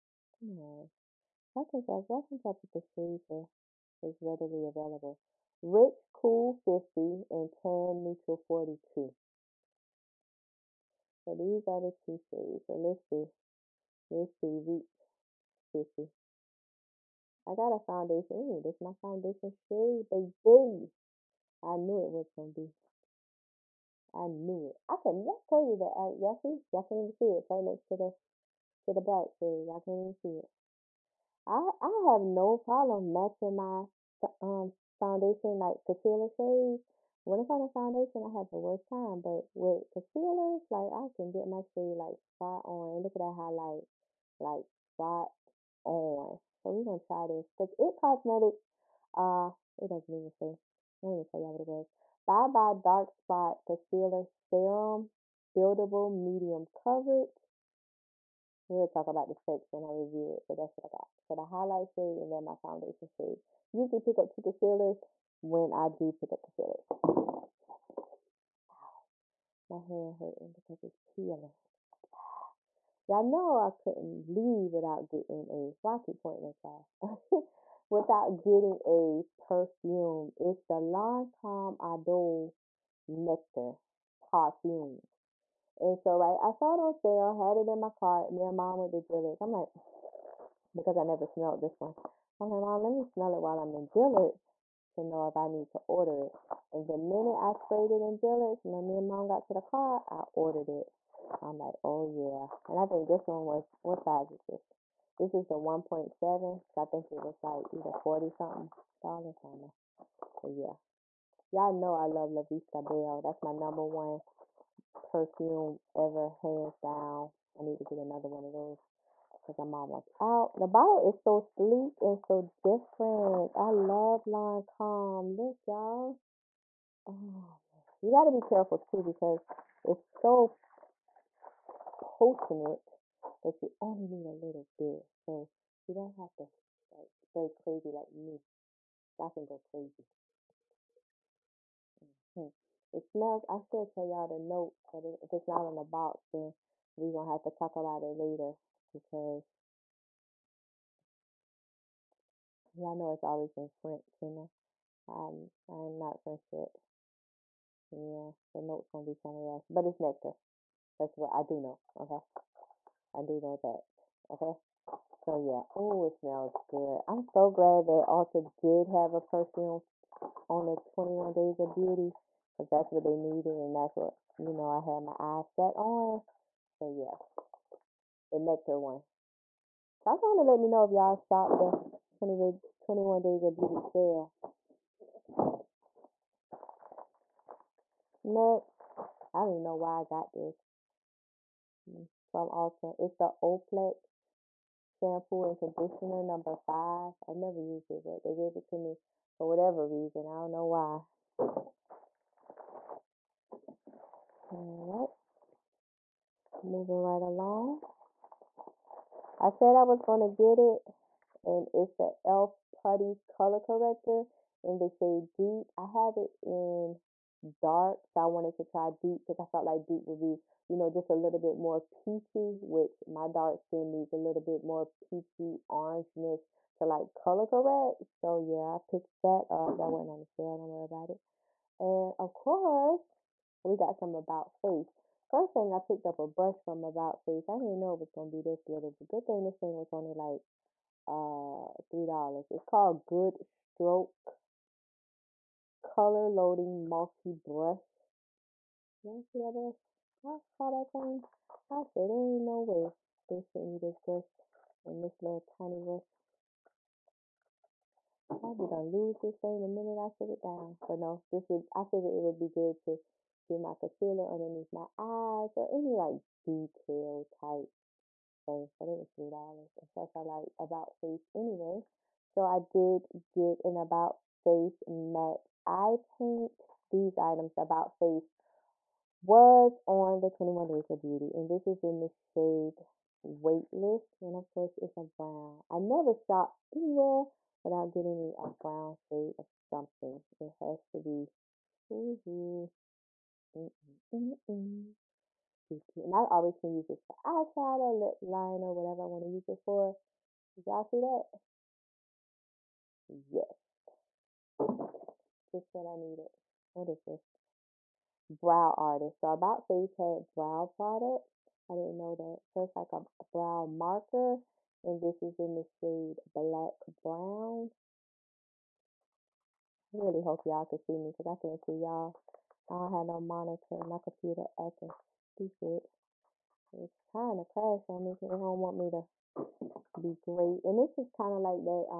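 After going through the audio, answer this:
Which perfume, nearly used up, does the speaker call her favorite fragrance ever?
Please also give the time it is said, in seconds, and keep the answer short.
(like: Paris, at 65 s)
La Vie Est Belle, at 112 s.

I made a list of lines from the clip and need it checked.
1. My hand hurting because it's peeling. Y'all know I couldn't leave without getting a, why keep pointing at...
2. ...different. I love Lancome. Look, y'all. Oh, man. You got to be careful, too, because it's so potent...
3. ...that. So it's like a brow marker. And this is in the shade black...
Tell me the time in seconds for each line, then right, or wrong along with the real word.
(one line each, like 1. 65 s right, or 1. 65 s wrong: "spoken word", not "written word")
1. 69 s right
2. 122 s right
3. 312 s right.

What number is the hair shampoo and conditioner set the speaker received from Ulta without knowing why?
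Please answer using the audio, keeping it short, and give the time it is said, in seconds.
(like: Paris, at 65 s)
5, at 196 s.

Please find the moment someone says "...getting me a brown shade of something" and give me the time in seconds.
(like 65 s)
287 s.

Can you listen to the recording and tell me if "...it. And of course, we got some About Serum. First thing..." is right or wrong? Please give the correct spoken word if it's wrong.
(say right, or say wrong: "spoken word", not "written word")
wrong: "Face", not "Serum".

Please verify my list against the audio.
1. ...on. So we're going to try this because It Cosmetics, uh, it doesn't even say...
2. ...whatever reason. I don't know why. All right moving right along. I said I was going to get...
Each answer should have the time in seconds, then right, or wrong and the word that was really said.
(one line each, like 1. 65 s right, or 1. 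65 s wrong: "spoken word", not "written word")
1. 45 s right
2. 199 s right.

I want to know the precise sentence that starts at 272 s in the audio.
So I did get an About Face matte eye paint.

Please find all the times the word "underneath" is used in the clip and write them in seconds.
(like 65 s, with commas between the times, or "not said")
264 s.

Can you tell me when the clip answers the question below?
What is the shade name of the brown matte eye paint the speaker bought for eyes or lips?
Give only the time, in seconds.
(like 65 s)
283 s.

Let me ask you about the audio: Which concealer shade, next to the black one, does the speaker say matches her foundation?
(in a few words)
Rich Cool 50.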